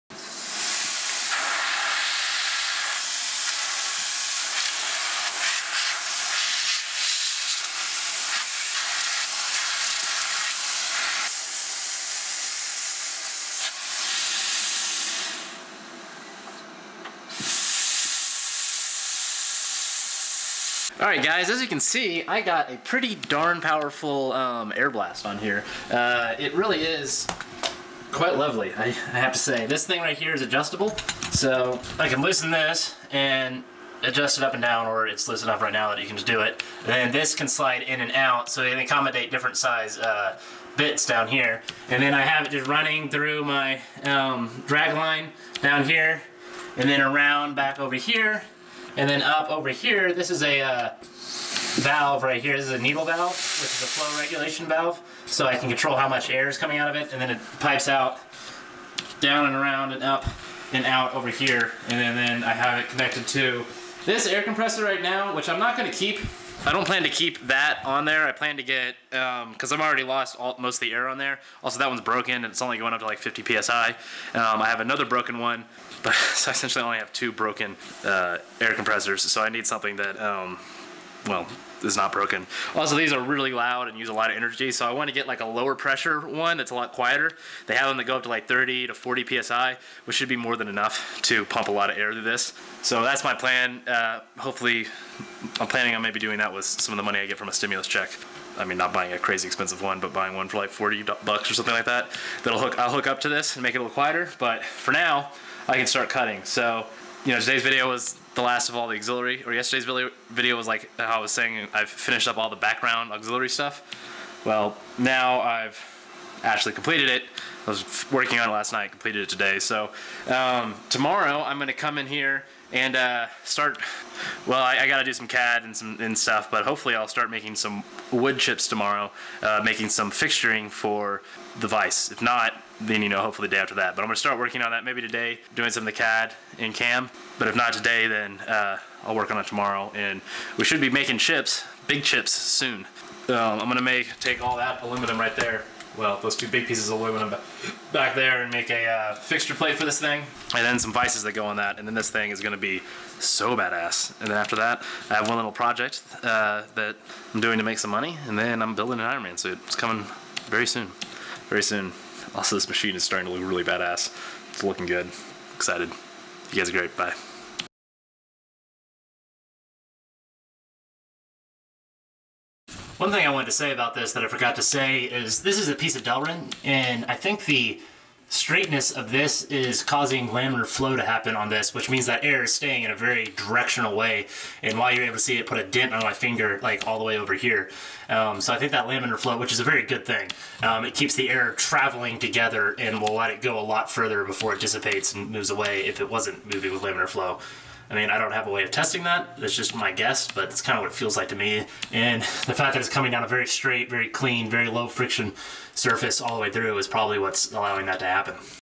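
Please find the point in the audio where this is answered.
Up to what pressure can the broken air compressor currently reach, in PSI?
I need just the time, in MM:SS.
01:13.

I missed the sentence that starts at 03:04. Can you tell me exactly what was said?
And while you're able to see it put a dent on my finger, like all the way over here.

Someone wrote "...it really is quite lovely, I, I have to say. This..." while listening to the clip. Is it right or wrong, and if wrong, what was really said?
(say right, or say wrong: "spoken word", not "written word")
right.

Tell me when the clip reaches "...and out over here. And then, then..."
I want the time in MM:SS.
01:00.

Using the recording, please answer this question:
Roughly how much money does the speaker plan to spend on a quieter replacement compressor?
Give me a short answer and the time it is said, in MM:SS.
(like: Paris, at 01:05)
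40 bucks, at 01:40.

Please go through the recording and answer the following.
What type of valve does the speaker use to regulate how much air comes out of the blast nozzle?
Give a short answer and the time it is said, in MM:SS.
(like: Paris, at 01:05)
needle valve, at 00:52.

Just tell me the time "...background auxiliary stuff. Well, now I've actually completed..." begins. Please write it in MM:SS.
01:52.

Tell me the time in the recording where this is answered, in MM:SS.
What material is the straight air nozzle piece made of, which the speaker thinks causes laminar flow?
02:56.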